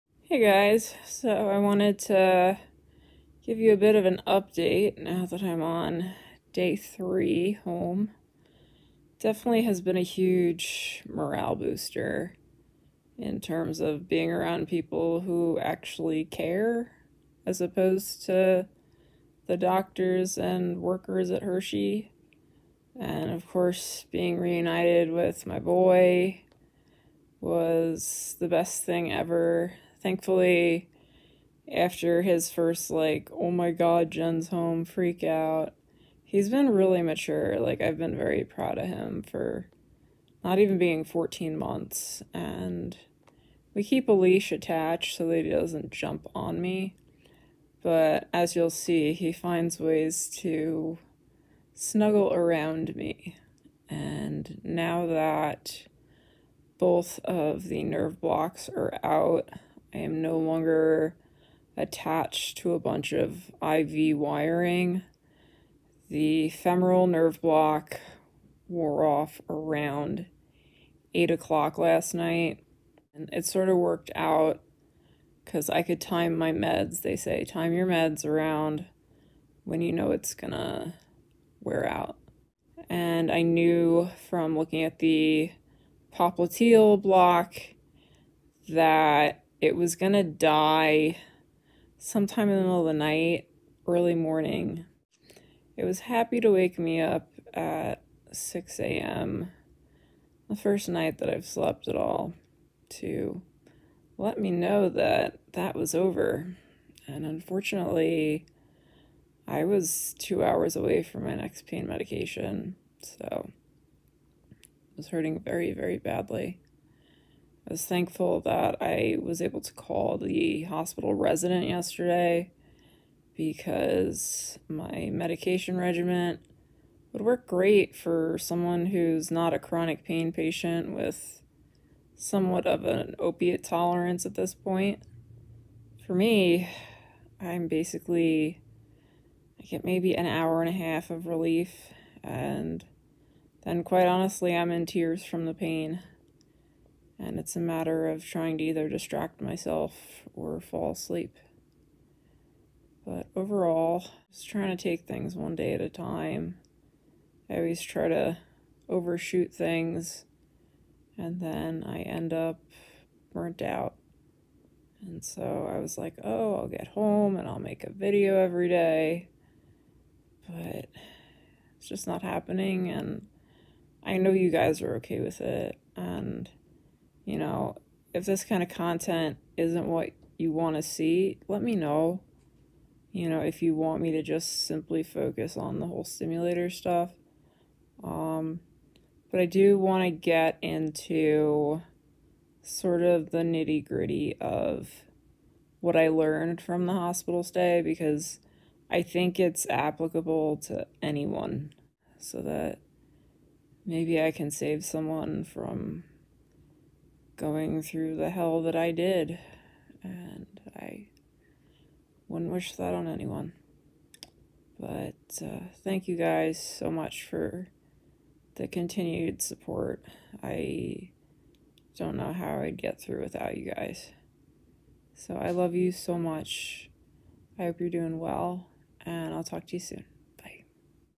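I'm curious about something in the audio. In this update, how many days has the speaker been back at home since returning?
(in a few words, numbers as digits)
3.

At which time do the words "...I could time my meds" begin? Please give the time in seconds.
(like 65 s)
75 s.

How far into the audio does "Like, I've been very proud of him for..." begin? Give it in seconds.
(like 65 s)
37 s.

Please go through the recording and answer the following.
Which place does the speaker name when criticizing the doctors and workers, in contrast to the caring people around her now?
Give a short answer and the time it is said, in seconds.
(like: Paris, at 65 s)
Hershey, at 21 s.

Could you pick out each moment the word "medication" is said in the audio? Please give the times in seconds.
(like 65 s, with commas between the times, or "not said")
111 s, 125 s.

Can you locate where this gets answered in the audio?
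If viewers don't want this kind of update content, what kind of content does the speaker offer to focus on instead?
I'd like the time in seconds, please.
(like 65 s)
186 s.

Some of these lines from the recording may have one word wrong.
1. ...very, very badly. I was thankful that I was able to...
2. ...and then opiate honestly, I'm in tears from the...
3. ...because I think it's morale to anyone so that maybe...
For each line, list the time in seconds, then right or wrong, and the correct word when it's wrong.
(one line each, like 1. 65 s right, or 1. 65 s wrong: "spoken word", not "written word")
1. 115 s right
2. 142 s wrong: "quite", not "opiate"
3. 197 s wrong: "applicable", not "morale".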